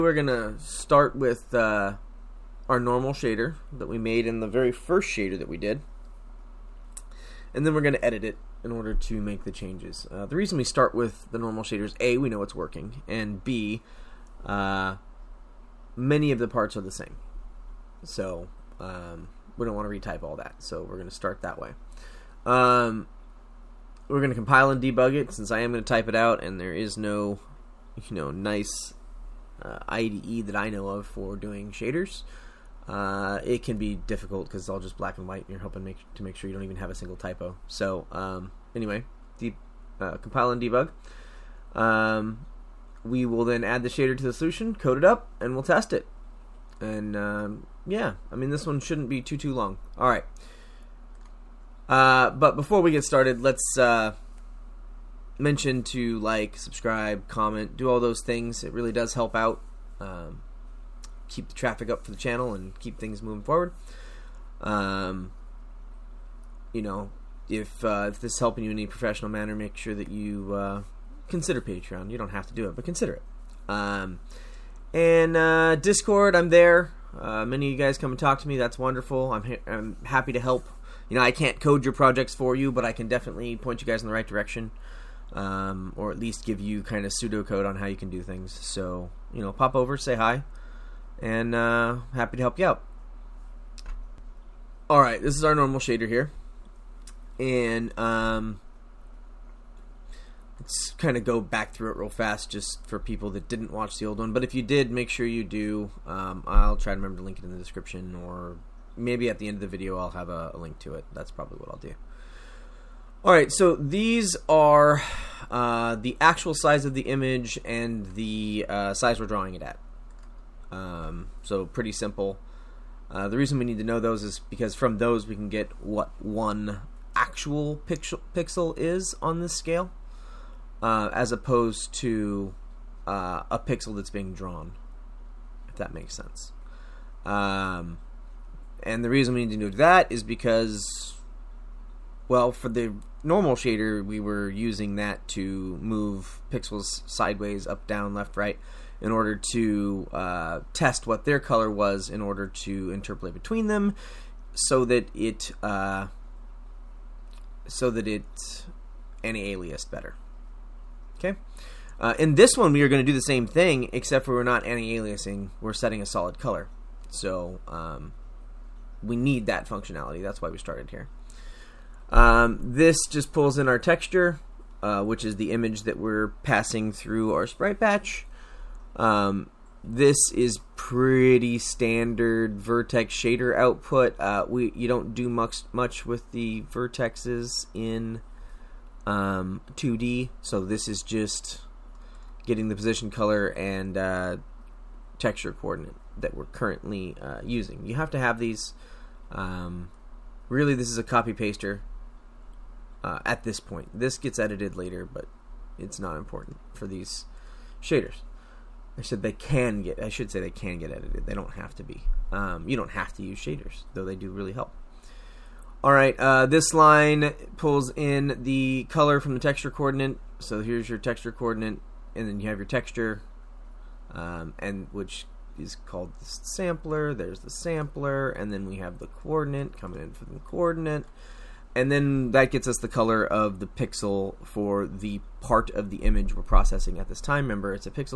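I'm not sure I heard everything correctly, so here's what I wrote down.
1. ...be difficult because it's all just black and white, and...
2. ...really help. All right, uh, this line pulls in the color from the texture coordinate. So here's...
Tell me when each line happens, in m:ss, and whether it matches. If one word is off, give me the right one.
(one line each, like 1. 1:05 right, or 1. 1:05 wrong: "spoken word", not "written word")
1. 0:33 right
2. 3:34 right.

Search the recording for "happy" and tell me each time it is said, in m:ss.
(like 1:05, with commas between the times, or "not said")
1:20, 1:32.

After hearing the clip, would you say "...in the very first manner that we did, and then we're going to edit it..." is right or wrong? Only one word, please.
wrong.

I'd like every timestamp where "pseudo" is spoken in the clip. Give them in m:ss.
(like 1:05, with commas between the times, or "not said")
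1:27.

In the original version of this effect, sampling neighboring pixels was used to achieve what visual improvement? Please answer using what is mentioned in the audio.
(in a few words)
Anti-aliasing.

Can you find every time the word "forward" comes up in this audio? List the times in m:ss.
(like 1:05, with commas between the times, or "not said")
1:03.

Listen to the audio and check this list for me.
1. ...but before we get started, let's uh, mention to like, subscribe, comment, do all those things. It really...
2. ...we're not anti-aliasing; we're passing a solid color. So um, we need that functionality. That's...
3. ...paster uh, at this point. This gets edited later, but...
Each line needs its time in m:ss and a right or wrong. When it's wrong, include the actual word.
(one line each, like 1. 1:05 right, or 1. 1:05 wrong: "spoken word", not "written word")
1. 0:52 right
2. 2:44 wrong: "setting", not "passing"
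3. 3:21 right.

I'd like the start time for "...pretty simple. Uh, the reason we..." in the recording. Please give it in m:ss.
2:01.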